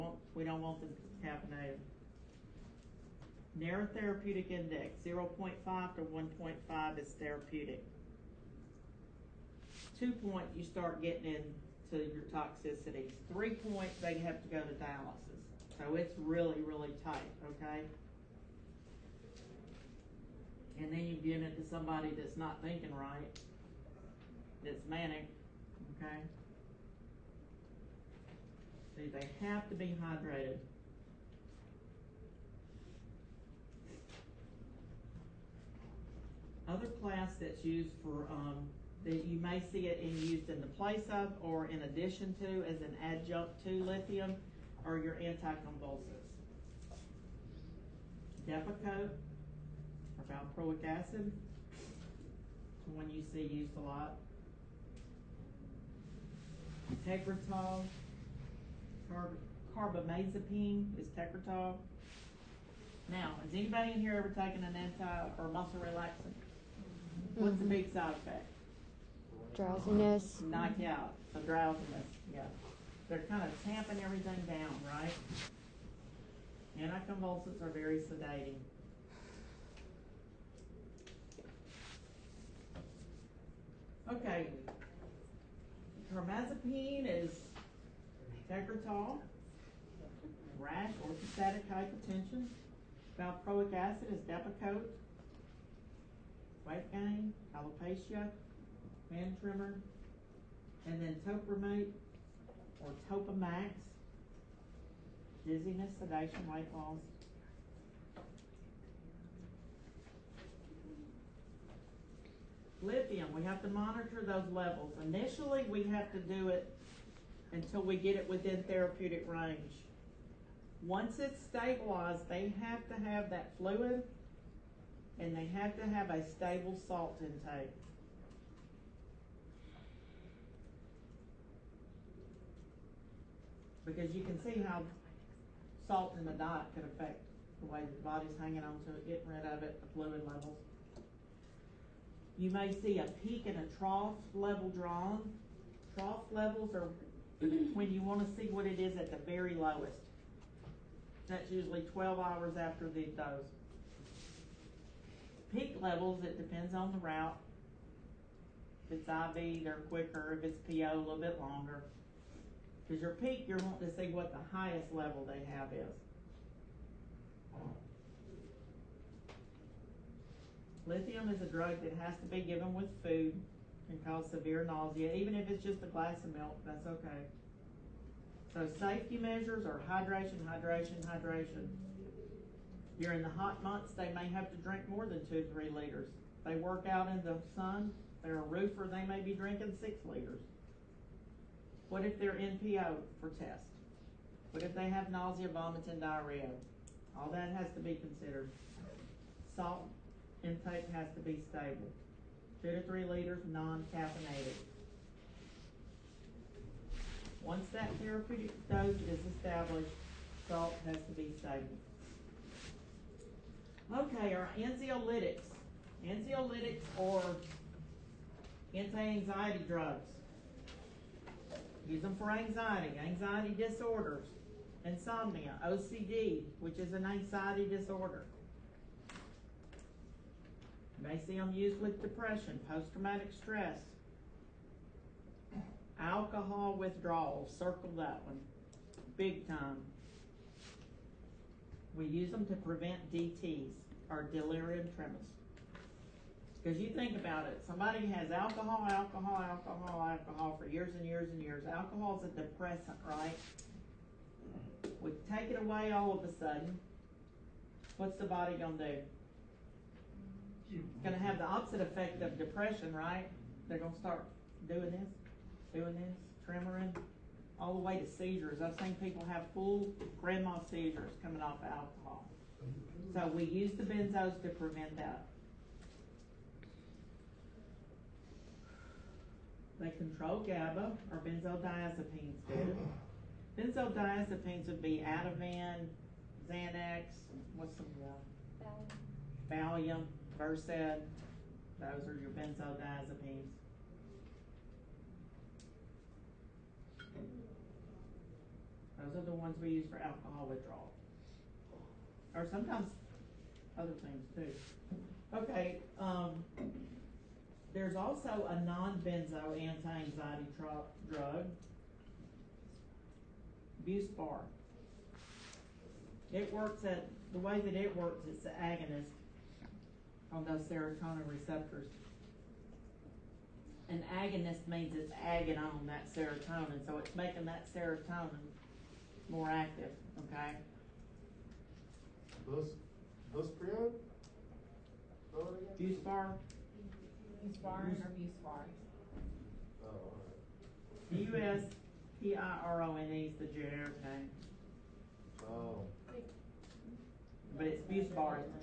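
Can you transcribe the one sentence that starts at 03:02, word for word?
During the hot months, they may have to drink more than two, three liters.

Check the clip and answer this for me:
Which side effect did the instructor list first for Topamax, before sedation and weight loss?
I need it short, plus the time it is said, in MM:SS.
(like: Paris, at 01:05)
dizziness, at 01:45.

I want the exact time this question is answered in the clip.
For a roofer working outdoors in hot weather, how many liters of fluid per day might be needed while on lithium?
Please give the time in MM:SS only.
03:09.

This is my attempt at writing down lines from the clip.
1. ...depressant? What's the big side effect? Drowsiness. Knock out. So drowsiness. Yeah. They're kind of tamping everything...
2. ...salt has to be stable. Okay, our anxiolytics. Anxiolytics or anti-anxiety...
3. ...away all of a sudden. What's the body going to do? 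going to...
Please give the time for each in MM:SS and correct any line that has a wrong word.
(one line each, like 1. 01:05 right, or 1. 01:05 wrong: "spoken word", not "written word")
1. 01:05 wrong: "relaxant", not "depressant"
2. 03:30 right
3. 04:15 right.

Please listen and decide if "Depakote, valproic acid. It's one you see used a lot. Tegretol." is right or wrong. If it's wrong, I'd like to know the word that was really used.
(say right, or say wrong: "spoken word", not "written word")
right.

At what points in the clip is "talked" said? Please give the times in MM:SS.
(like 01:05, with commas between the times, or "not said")
not said.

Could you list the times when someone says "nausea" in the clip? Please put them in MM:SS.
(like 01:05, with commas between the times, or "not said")
02:54, 03:15.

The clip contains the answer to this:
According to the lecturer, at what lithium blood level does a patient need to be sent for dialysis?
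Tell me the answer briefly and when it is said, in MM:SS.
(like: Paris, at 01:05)
3, at 00:13.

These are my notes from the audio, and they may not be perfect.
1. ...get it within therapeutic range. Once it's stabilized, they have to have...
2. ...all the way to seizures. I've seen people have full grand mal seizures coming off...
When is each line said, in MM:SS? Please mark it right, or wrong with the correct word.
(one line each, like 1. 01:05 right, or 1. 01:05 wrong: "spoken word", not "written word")
1. 01:57 right
2. 04:27 right.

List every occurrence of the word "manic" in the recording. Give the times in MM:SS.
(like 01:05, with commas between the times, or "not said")
00:24.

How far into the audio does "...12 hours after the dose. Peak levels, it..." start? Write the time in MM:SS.
02:31.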